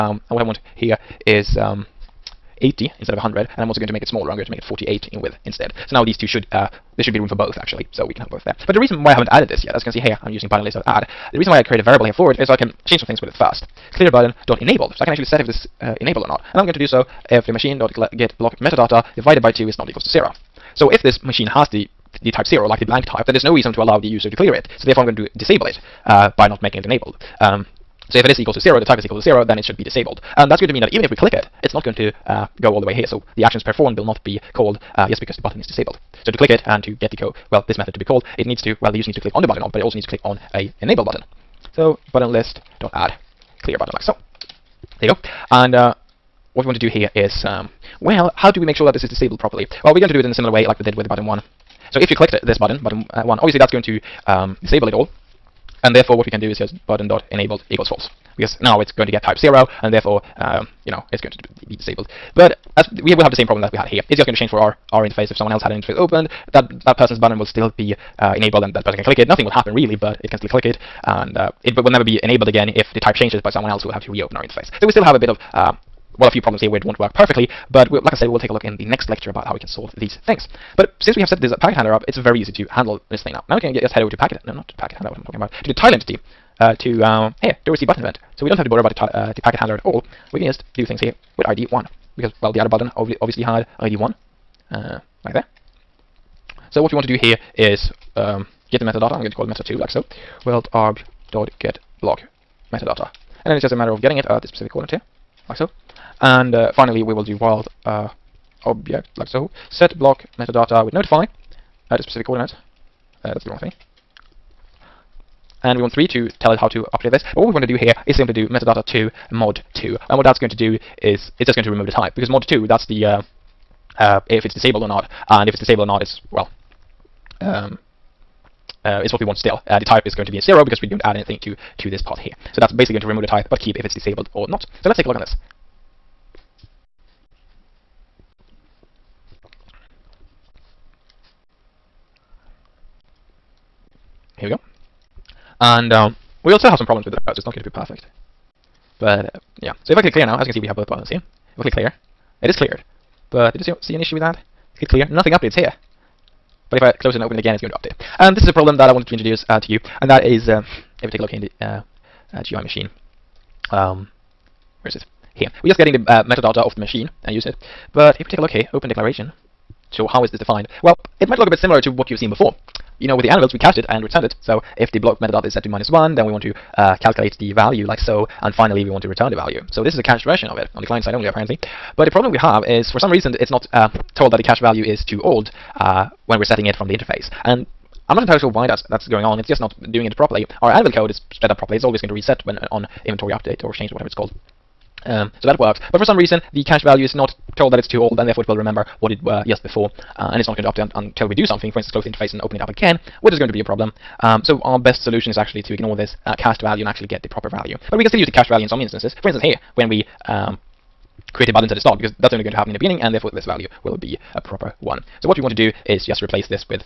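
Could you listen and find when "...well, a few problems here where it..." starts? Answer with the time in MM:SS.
01:16.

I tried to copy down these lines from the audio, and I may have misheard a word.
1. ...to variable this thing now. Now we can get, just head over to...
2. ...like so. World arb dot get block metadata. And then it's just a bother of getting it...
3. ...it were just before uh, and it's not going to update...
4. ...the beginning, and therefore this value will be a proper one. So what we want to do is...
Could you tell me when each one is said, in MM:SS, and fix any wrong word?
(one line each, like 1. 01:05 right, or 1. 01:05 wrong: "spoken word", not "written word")
1. 01:22 wrong: "handle", not "variable"
2. 01:39 wrong: "matter", not "bother"
3. 03:19 right
4. 03:32 right.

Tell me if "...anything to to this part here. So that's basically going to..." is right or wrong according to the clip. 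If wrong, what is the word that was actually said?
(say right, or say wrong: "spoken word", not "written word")
right.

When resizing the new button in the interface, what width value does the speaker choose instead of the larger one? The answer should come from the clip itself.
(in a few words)
48.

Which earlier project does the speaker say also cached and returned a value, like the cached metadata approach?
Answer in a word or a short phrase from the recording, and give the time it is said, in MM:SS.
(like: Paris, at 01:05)
anvils, at 02:53.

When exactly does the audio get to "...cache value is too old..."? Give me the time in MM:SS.
03:04.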